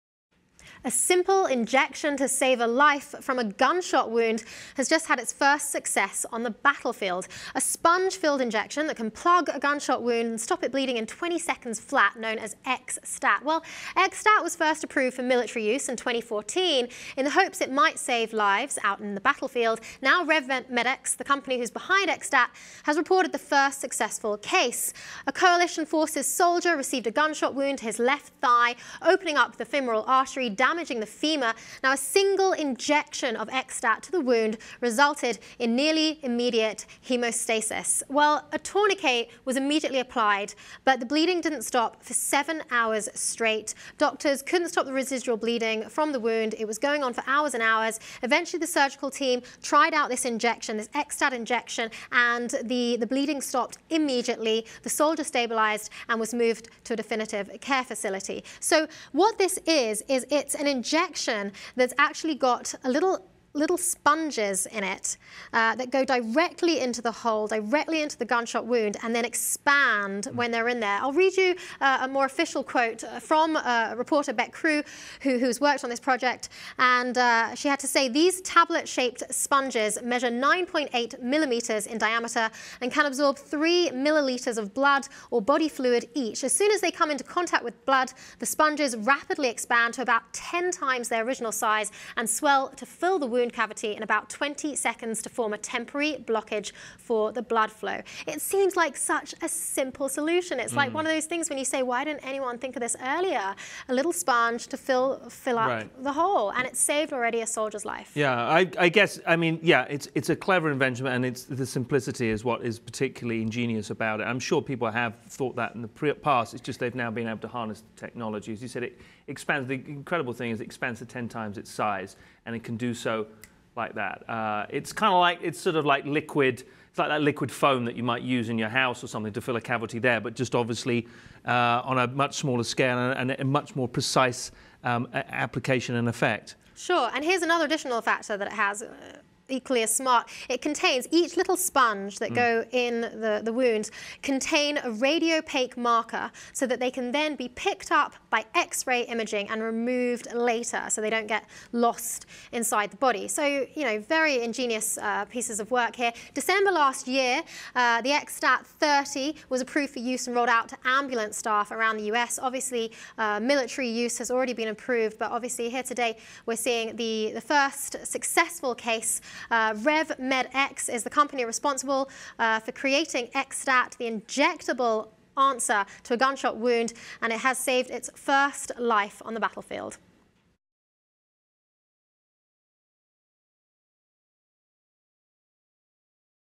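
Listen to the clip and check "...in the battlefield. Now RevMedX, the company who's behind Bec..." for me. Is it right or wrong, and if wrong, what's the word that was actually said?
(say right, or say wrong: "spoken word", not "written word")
wrong: "XSTAT", not "Bec".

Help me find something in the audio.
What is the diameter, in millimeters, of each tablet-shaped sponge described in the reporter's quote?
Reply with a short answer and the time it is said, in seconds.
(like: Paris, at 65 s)
9.8, at 80 s.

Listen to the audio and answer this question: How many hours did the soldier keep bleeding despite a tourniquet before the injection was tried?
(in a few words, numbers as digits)
7.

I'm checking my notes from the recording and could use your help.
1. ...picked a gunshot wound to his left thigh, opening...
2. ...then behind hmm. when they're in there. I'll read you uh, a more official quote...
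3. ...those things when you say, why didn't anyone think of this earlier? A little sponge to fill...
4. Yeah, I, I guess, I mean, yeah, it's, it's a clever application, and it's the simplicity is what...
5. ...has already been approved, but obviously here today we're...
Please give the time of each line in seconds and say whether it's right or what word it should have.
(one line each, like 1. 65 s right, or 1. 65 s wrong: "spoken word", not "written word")
1. 26 s wrong: "received", not "picked"
2. 69 s wrong: "expand", not "behind"
3. 101 s right
4. 108 s wrong: "invention", not "application"
5. 164 s right.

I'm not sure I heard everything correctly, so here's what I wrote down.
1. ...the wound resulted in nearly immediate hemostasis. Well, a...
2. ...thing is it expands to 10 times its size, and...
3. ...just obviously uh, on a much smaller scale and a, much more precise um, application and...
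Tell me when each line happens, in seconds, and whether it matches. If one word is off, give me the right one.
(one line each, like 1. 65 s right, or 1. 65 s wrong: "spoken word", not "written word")
1. 34 s right
2. 120 s right
3. 130 s right.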